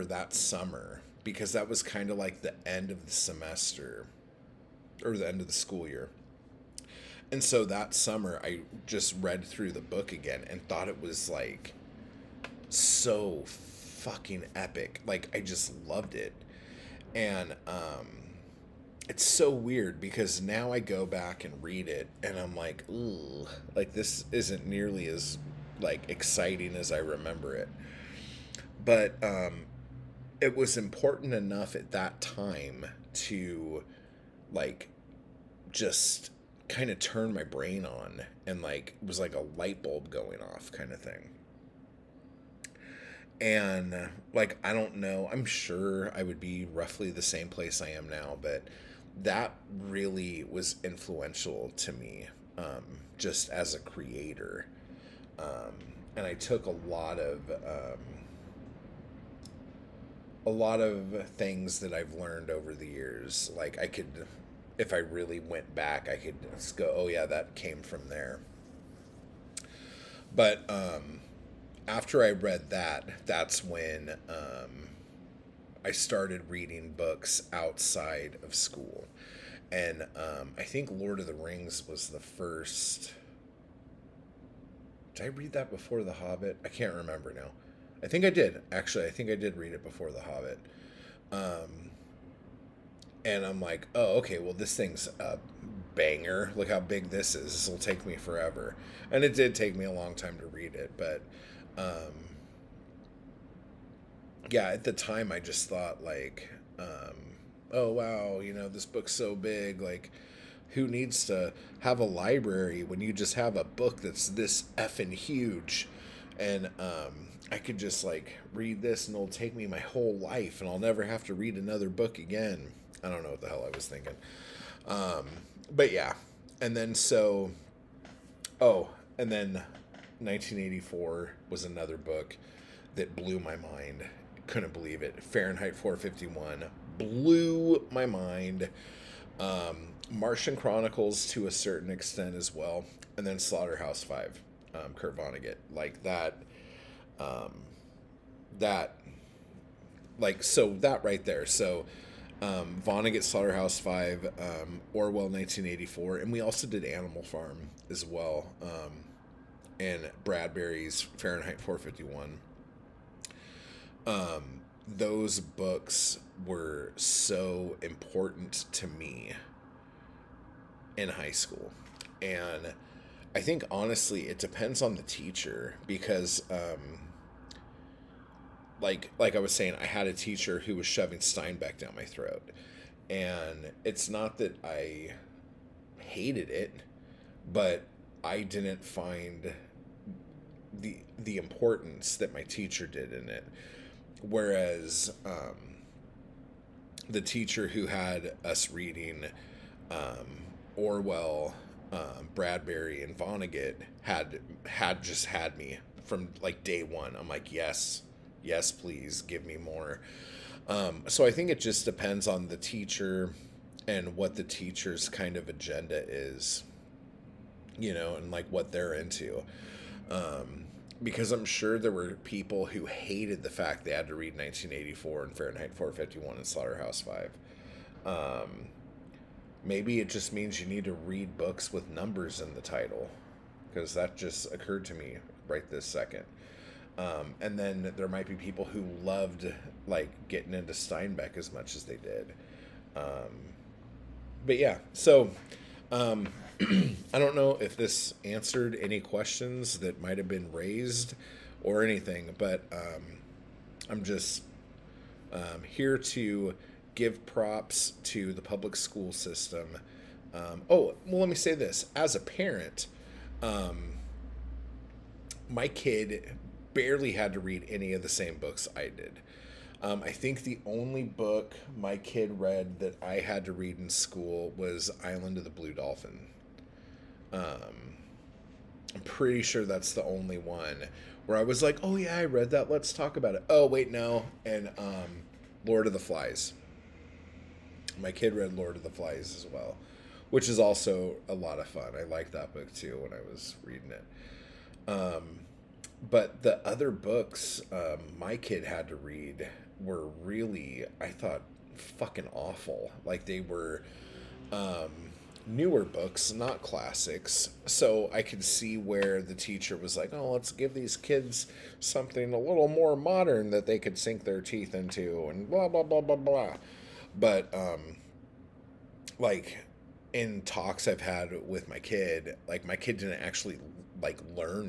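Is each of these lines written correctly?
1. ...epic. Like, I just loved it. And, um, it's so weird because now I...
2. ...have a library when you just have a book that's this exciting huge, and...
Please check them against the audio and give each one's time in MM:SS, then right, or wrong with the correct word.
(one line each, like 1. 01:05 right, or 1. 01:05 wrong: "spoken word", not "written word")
1. 00:14 right
2. 01:51 wrong: "effing", not "exciting".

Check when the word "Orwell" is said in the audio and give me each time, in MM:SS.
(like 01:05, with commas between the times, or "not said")
02:34, 03:20.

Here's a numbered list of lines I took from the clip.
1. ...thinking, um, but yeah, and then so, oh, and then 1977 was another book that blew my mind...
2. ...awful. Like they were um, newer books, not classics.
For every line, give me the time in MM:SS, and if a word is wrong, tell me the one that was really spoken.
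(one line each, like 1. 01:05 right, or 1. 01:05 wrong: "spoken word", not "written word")
1. 02:03 wrong: "1984", not "1977"
2. 05:02 right.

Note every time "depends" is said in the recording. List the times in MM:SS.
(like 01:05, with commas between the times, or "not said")
02:54, 03:31.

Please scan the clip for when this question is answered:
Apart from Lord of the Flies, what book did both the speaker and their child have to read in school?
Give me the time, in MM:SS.
04:35.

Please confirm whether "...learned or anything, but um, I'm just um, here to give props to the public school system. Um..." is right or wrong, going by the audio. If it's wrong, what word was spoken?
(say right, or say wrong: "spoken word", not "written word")
wrong: "raised", not "learned".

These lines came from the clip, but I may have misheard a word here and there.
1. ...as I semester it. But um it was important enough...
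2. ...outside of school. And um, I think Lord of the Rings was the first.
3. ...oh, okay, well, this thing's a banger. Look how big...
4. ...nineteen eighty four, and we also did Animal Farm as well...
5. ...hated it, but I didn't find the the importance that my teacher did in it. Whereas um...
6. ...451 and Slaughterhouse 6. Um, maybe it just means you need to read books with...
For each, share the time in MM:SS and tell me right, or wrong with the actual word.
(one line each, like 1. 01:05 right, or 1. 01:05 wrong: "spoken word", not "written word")
1. 00:26 wrong: "remember", not "semester"
2. 01:17 right
3. 01:33 right
4. 02:35 right
5. 03:05 right
6. 03:45 wrong: "5", not "6".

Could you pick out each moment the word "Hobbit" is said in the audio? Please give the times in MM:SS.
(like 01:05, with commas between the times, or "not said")
01:26, 01:30.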